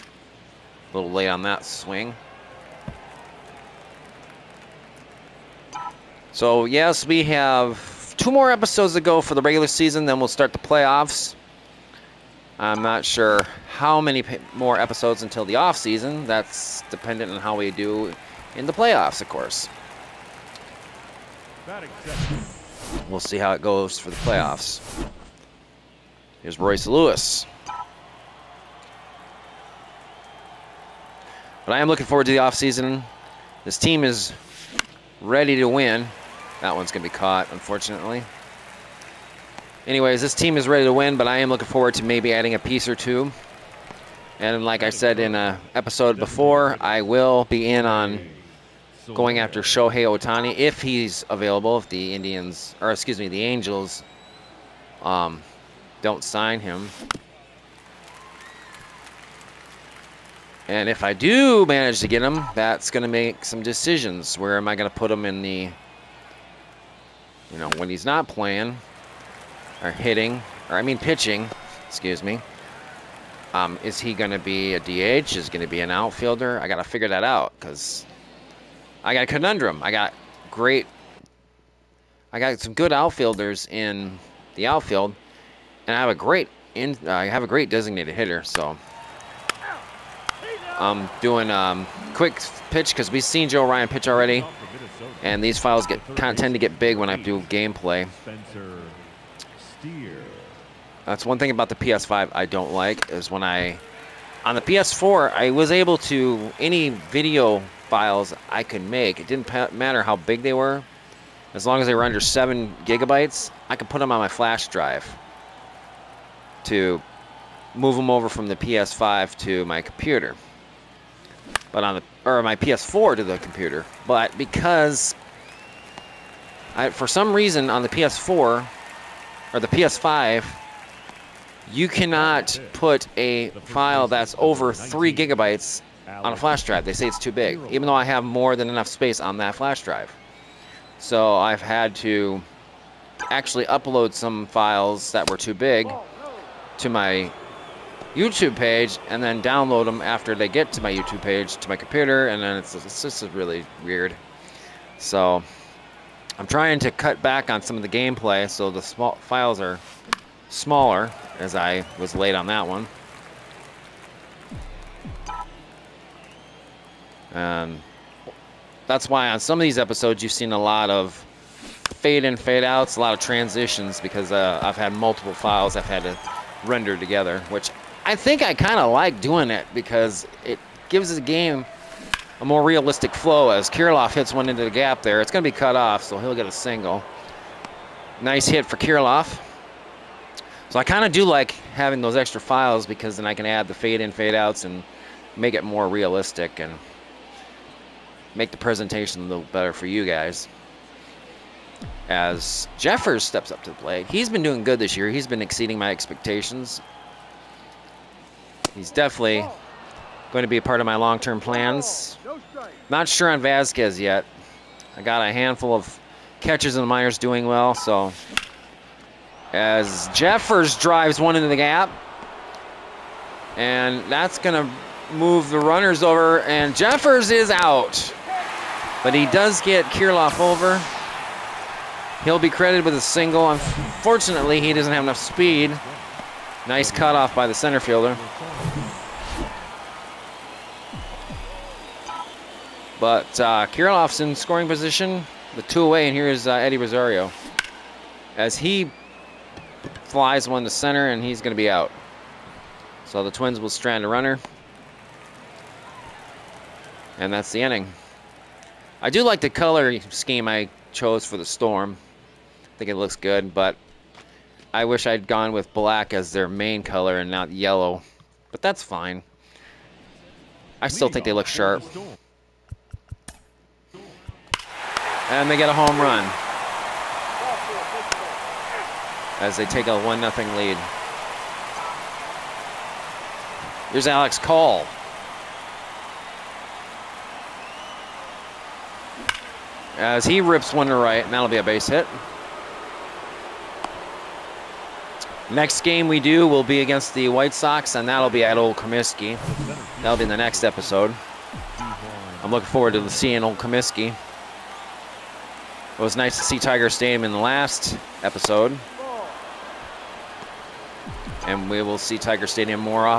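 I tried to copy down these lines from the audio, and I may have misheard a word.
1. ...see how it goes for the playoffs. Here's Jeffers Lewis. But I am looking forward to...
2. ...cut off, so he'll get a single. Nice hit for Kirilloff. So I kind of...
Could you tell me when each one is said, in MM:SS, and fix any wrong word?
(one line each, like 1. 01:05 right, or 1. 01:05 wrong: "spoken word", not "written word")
1. 00:23 wrong: "Royce", not "Jeffers"
2. 03:05 right.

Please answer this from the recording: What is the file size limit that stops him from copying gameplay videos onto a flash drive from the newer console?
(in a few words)
3 gigabytes.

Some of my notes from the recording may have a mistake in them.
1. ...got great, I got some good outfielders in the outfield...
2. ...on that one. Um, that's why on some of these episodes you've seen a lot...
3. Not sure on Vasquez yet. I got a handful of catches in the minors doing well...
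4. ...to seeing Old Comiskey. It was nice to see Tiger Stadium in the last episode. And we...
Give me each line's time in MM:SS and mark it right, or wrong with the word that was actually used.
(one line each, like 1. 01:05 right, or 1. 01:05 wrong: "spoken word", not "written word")
1. 01:19 right
2. 02:42 right
3. 03:32 right
4. 05:02 right.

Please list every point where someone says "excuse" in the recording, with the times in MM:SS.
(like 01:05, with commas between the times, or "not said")
00:52, 01:11.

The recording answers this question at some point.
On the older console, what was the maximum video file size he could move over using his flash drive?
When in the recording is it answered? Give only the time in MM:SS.
01:52.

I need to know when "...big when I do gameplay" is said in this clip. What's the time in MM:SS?
01:36.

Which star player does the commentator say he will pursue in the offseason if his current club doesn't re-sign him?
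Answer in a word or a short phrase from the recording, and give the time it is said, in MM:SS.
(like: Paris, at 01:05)
Shohei Ohtani, at 00:49.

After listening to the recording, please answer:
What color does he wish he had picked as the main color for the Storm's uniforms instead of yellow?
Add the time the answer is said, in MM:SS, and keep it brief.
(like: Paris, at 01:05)
Black, at 04:25.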